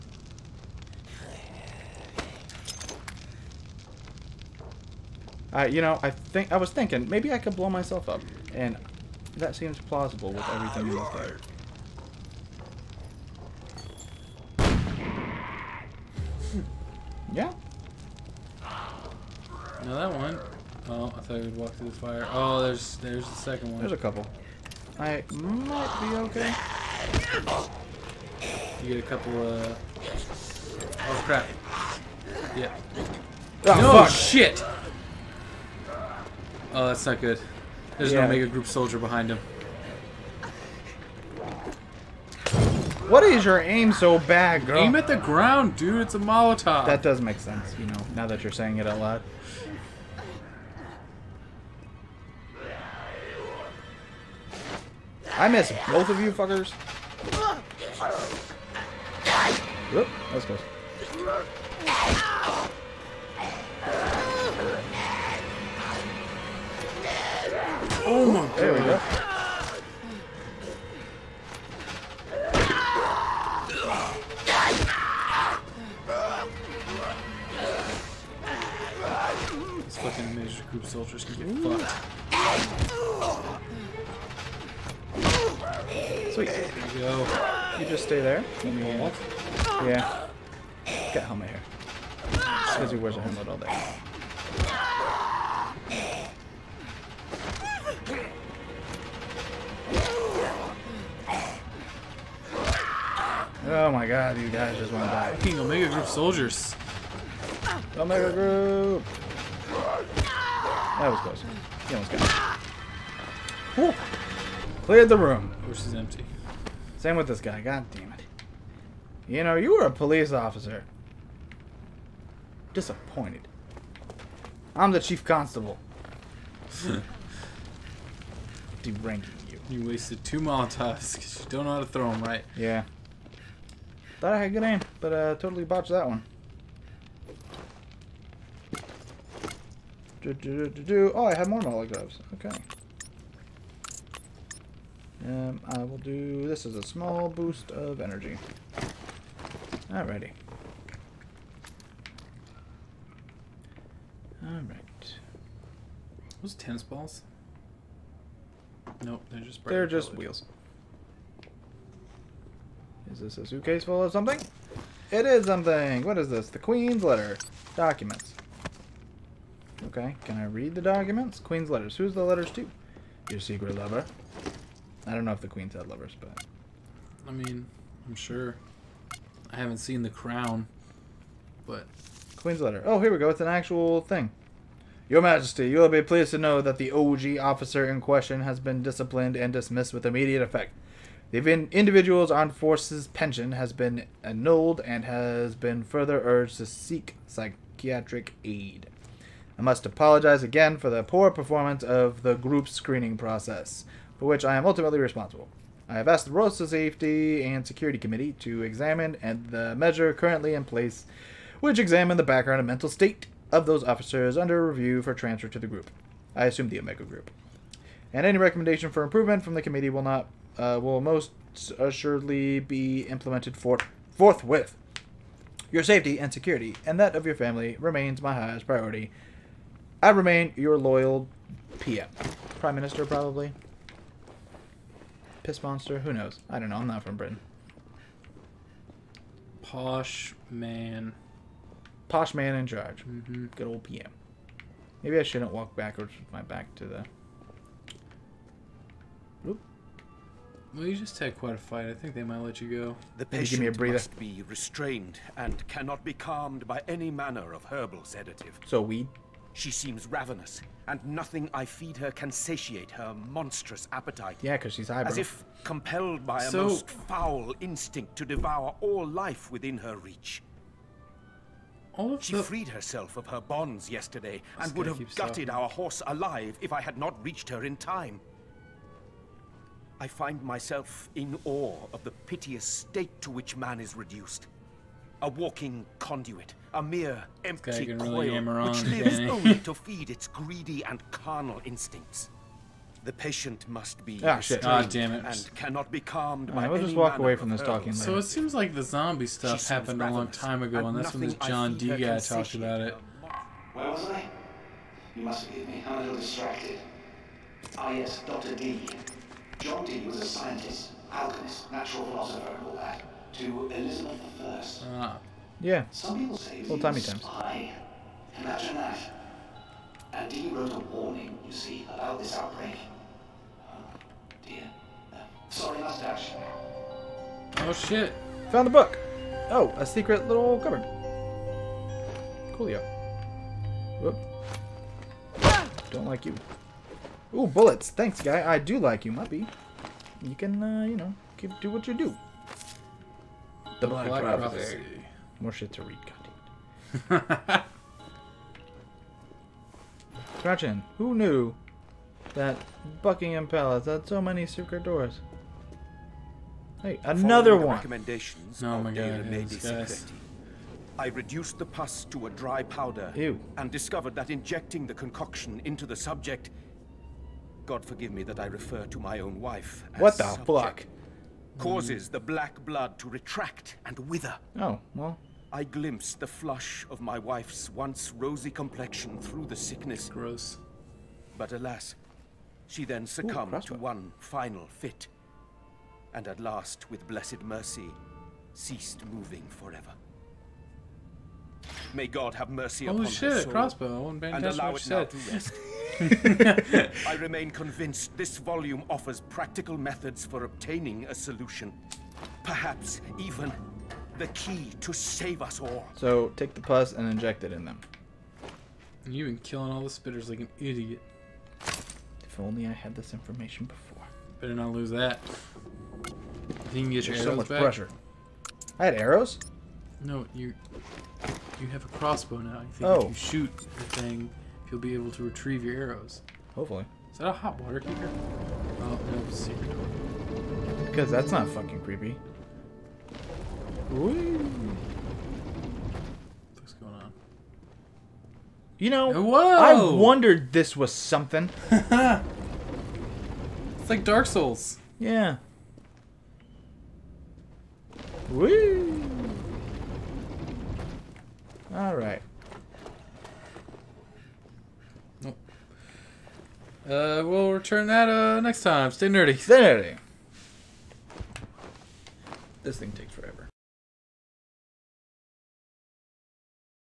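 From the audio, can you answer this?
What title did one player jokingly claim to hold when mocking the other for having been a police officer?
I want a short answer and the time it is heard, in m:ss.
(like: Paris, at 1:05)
Chief constable, at 2:05.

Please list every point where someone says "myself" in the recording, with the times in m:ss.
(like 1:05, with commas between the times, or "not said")
0:07, 4:40.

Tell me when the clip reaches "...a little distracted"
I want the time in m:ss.
5:05.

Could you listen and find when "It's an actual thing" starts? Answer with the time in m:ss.
3:03.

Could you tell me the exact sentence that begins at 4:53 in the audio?
The patient must be ah, shit.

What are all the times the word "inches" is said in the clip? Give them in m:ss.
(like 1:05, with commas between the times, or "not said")
not said.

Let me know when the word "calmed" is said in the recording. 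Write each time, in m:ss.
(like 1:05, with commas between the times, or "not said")
4:16, 4:55.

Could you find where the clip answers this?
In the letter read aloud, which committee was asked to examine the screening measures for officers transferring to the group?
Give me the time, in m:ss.
3:26.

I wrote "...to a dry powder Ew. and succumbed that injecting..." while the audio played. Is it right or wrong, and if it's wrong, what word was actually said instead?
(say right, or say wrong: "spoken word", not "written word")
wrong: "discovered", not "succumbed".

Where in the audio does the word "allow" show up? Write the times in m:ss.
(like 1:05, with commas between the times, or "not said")
6:34.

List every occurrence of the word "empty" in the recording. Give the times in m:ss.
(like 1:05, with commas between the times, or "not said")
1:55, 4:47.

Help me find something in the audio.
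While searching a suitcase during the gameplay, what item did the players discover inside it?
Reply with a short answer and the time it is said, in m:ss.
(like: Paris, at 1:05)
The Queen's letter, at 2:46.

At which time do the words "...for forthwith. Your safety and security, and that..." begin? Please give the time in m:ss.
3:43.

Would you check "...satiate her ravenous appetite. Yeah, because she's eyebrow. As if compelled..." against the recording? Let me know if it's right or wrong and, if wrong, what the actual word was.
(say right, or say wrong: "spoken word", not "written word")
wrong: "monstrous", not "ravenous".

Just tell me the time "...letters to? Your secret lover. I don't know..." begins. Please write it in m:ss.
2:52.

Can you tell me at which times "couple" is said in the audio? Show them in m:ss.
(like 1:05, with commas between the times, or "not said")
0:23, 0:29.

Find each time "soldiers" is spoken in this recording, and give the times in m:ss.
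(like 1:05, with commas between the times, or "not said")
0:38, 1:20, 1:46.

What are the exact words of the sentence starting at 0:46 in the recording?
That does make sense, you know, now that you're saying it out loud.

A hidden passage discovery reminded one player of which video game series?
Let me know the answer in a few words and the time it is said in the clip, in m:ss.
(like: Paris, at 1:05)
Dark Souls, at 7:24.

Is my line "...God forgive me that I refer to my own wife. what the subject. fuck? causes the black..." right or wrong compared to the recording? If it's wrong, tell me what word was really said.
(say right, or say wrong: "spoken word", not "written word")
right.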